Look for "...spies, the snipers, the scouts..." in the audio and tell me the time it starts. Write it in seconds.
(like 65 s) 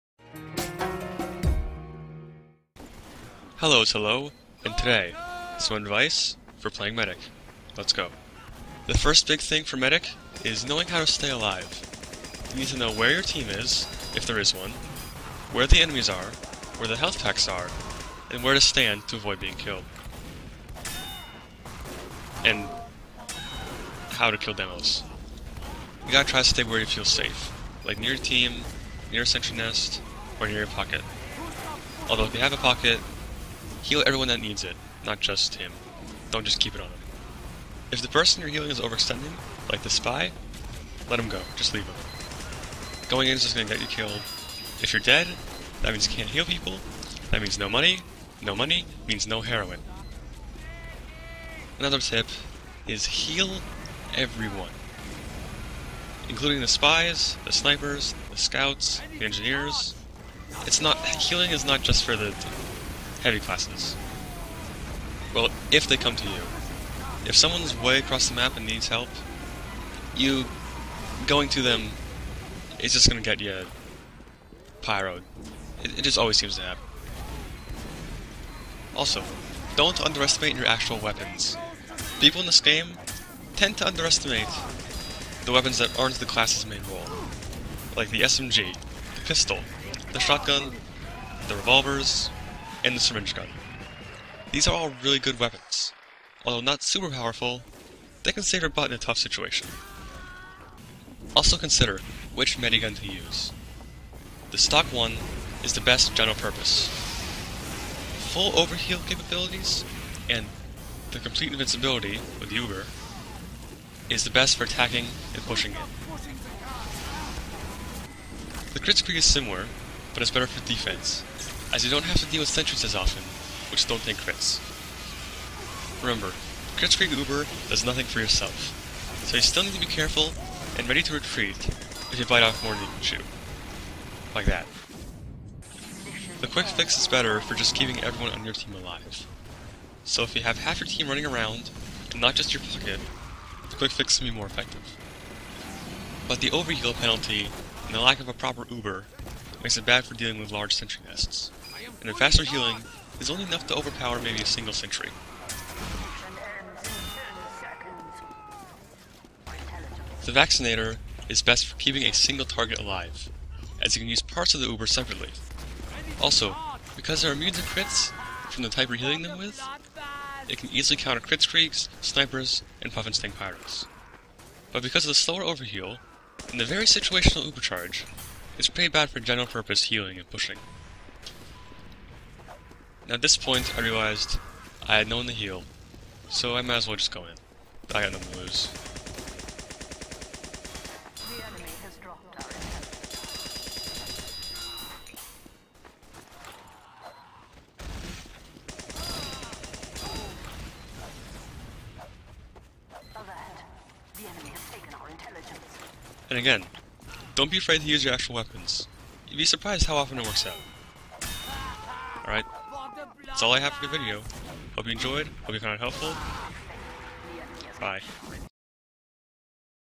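56 s.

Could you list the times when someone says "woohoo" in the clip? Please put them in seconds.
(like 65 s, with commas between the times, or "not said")
not said.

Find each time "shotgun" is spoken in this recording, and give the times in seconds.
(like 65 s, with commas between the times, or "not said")
90 s.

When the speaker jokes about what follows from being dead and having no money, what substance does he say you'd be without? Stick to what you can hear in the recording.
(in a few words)
heroin.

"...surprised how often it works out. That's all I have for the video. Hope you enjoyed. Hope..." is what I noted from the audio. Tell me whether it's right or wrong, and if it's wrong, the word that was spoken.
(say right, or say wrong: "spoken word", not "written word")
right.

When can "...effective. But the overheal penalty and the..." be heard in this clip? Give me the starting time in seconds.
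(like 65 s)
144 s.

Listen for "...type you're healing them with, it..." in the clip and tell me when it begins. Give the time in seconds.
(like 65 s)
168 s.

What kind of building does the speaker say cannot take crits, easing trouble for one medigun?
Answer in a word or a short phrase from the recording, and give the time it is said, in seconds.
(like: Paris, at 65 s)
sentries, at 122 s.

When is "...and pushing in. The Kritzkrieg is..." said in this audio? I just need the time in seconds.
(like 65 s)
115 s.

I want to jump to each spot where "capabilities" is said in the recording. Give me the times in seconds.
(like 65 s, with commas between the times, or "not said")
109 s.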